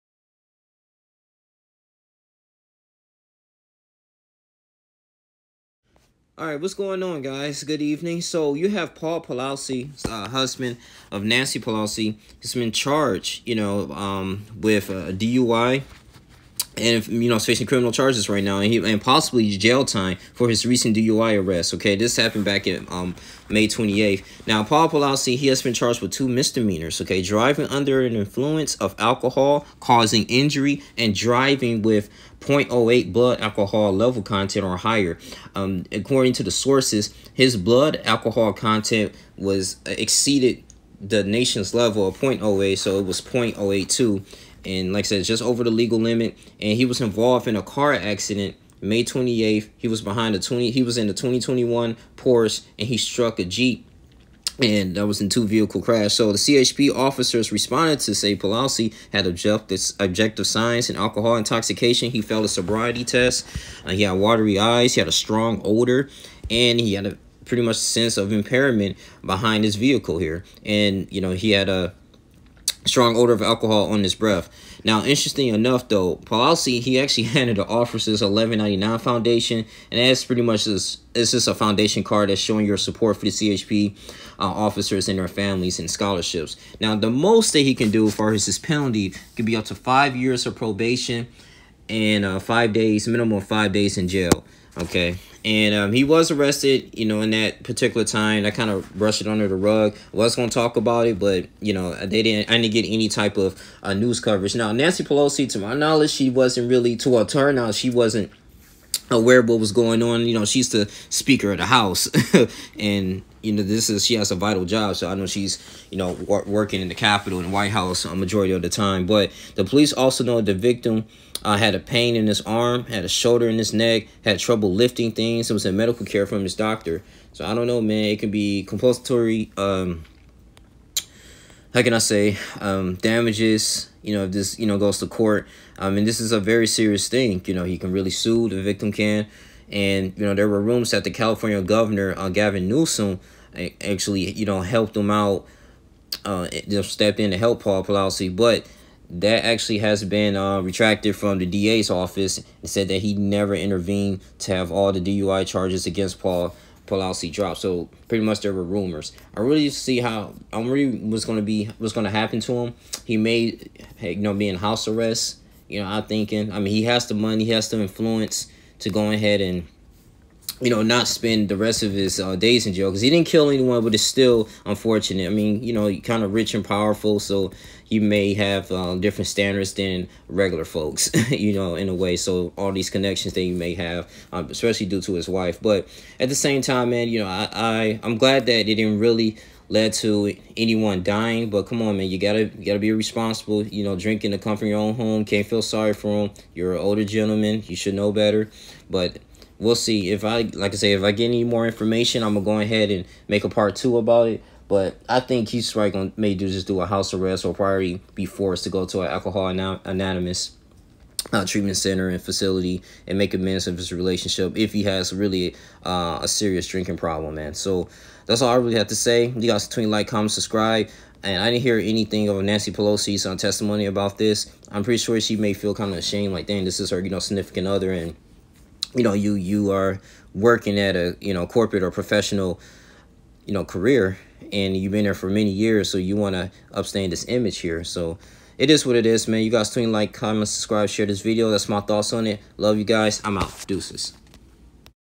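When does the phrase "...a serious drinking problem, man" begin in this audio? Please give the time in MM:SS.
03:36.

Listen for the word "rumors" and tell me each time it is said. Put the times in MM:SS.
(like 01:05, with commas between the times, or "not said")
02:20, 02:38.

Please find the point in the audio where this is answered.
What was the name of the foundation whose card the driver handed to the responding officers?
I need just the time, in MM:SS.
01:18.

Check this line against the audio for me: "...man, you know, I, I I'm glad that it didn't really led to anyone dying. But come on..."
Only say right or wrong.
right.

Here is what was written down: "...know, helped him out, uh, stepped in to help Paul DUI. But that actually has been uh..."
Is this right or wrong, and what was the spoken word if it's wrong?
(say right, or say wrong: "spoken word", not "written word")
wrong: "Pelosi", not "DUI".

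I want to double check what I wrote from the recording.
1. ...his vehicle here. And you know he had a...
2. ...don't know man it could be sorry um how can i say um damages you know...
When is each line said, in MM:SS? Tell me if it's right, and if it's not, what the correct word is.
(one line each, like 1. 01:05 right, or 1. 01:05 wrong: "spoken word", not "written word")
1. 01:09 right
2. 02:07 wrong: "compulsory", not "sorry".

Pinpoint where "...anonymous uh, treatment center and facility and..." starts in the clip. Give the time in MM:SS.
03:29.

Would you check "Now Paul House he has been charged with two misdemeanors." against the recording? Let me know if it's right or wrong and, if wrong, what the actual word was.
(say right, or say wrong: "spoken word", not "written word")
wrong: "Pelosi", not "House".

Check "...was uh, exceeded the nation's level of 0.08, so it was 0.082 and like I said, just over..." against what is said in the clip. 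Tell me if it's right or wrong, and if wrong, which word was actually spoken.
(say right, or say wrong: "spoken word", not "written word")
right.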